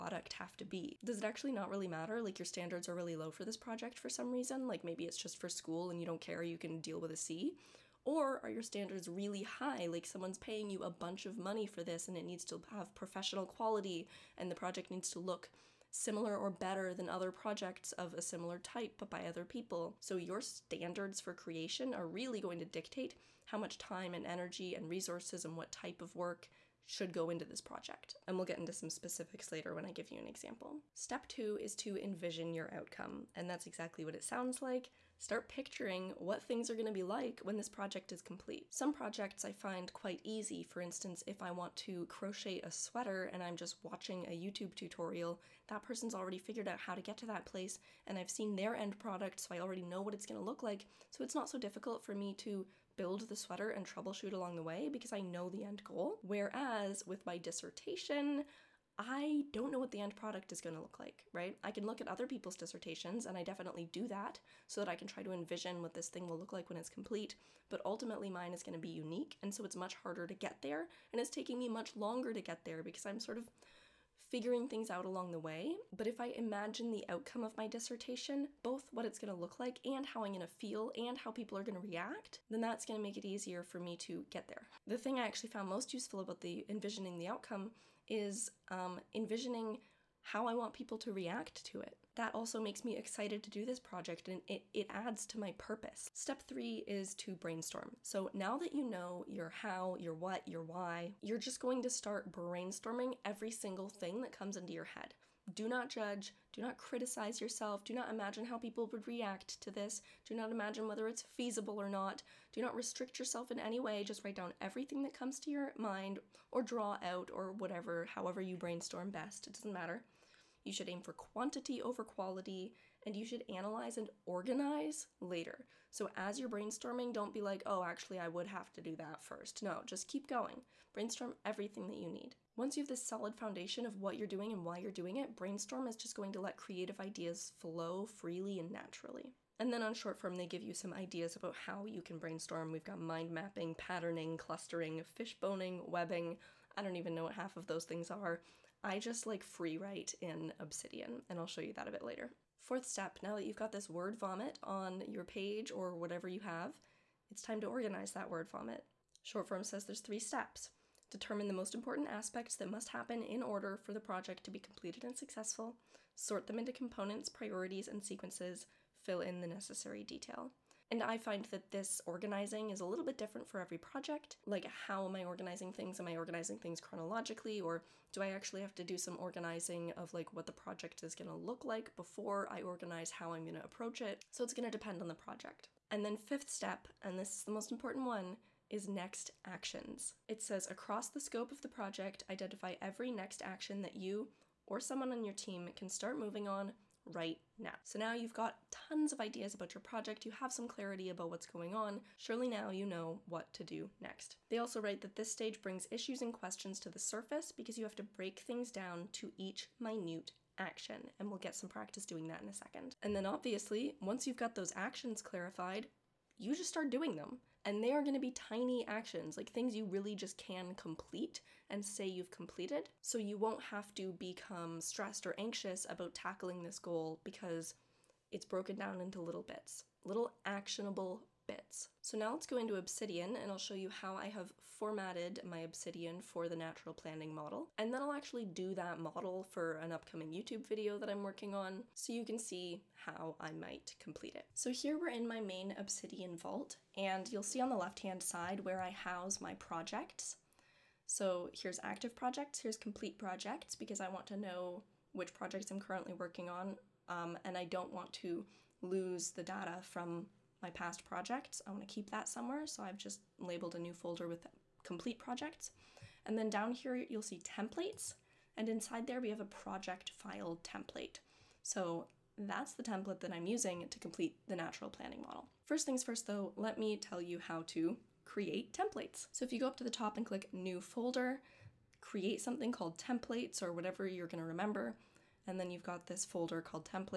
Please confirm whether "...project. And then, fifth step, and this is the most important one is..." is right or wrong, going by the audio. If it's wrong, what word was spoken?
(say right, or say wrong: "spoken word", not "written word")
right.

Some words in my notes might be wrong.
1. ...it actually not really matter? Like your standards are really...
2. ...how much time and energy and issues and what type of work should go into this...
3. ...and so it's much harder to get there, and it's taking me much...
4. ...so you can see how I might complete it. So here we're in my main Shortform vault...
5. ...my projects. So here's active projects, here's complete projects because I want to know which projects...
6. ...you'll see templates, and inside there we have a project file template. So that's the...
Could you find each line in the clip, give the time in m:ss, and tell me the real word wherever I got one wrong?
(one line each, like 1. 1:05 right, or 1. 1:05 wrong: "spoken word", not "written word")
1. 0:01 right
2. 0:23 wrong: "resources", not "issues"
3. 1:09 right
4. 4:01 wrong: "Obsidian", not "Shortform"
5. 4:09 right
6. 4:26 right.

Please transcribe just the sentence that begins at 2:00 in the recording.
You should aim for quantity over quality, and you should analyze and organize later.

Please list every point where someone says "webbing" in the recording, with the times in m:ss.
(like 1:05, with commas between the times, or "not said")
2:25.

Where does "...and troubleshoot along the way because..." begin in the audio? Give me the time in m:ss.
0:53.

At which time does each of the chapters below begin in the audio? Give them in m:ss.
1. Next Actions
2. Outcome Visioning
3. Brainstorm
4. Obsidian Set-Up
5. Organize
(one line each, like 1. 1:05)
1. 3:05
2. 0:30
3. 1:36
4. 3:51
5. 2:34.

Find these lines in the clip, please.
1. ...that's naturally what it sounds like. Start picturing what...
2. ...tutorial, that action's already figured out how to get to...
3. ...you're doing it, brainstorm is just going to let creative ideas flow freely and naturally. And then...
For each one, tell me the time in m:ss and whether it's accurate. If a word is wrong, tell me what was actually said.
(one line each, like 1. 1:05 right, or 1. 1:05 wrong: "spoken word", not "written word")
1. 0:33 wrong: "exactly", not "naturally"
2. 0:44 wrong: "person", not "action"
3. 2:14 right.